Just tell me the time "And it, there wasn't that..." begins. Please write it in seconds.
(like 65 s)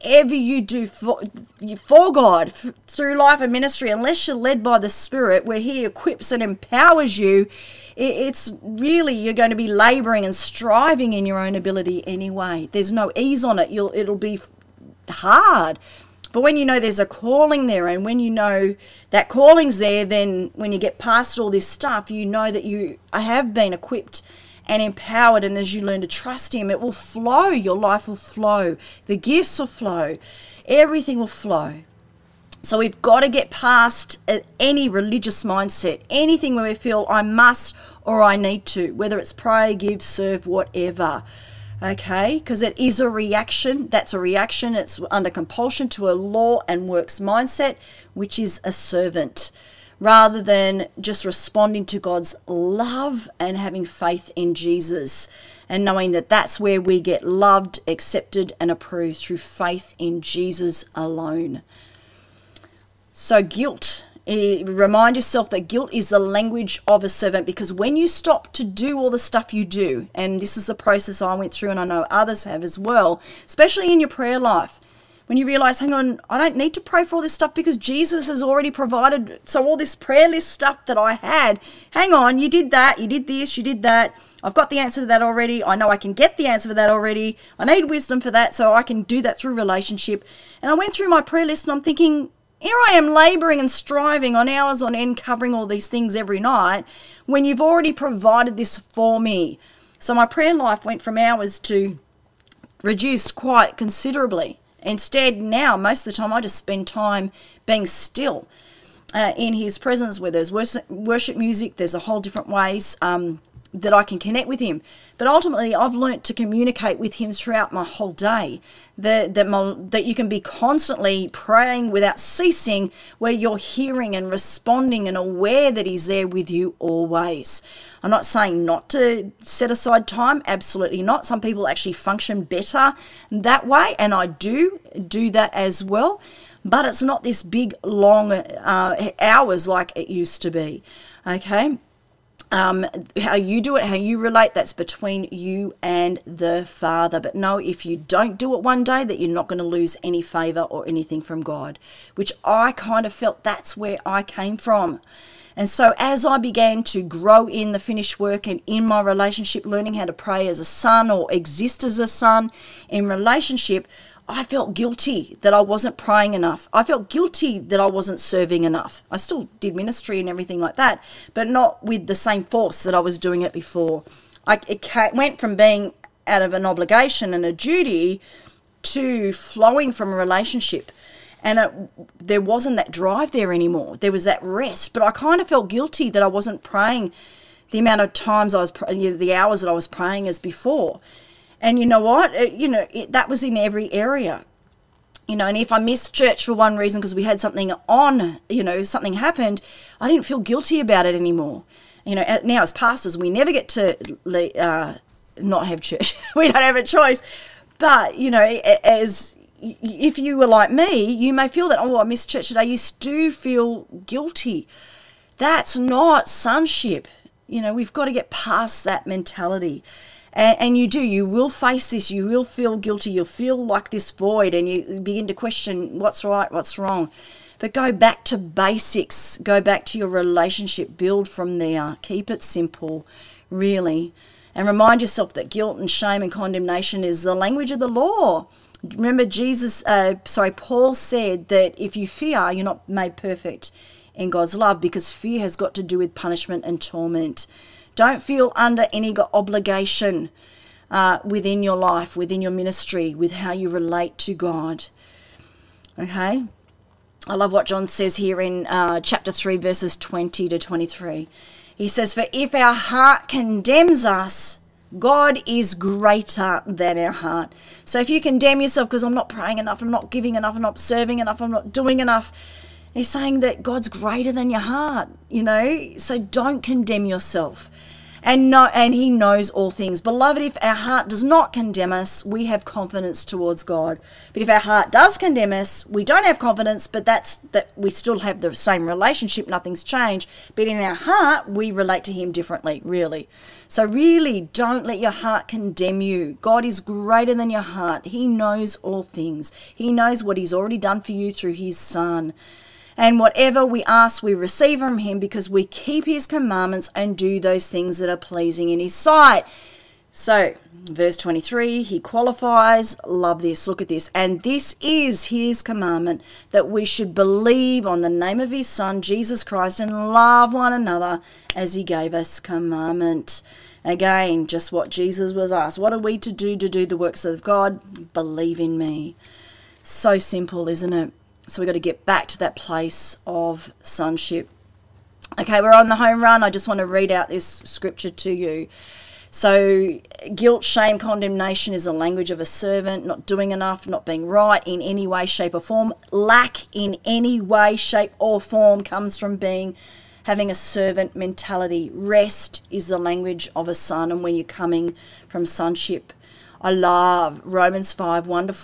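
181 s.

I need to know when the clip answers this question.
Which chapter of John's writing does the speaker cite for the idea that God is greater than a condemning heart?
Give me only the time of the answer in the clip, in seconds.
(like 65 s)
258 s.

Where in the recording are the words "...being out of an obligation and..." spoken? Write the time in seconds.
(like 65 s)
175 s.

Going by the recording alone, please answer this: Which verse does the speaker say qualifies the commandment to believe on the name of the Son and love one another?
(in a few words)
Verse 23.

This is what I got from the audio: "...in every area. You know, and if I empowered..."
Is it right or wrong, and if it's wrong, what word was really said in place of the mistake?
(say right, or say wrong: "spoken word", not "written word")
wrong: "missed", not "empowered".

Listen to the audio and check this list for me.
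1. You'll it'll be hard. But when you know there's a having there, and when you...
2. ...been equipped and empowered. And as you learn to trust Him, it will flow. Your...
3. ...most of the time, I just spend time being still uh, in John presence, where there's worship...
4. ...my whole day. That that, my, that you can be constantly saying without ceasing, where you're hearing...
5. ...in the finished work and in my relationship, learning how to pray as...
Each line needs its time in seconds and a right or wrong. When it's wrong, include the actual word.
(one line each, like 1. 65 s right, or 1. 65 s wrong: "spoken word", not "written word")
1. 13 s wrong: "calling", not "having"
2. 23 s right
3. 105 s wrong: "His", not "John"
4. 117 s wrong: "praying", not "saying"
5. 157 s right.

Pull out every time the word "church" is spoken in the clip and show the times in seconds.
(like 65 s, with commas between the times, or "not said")
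196 s, 205 s, 212 s.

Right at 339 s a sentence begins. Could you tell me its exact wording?
So, guilt, shame, condemnation is the language of a servant, not doing enough, not being right in any way, shape, or form.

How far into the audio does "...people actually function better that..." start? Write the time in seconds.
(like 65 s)
131 s.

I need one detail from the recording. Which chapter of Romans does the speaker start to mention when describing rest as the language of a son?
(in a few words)
Romans 5.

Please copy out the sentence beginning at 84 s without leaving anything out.
I've got the answer to that already.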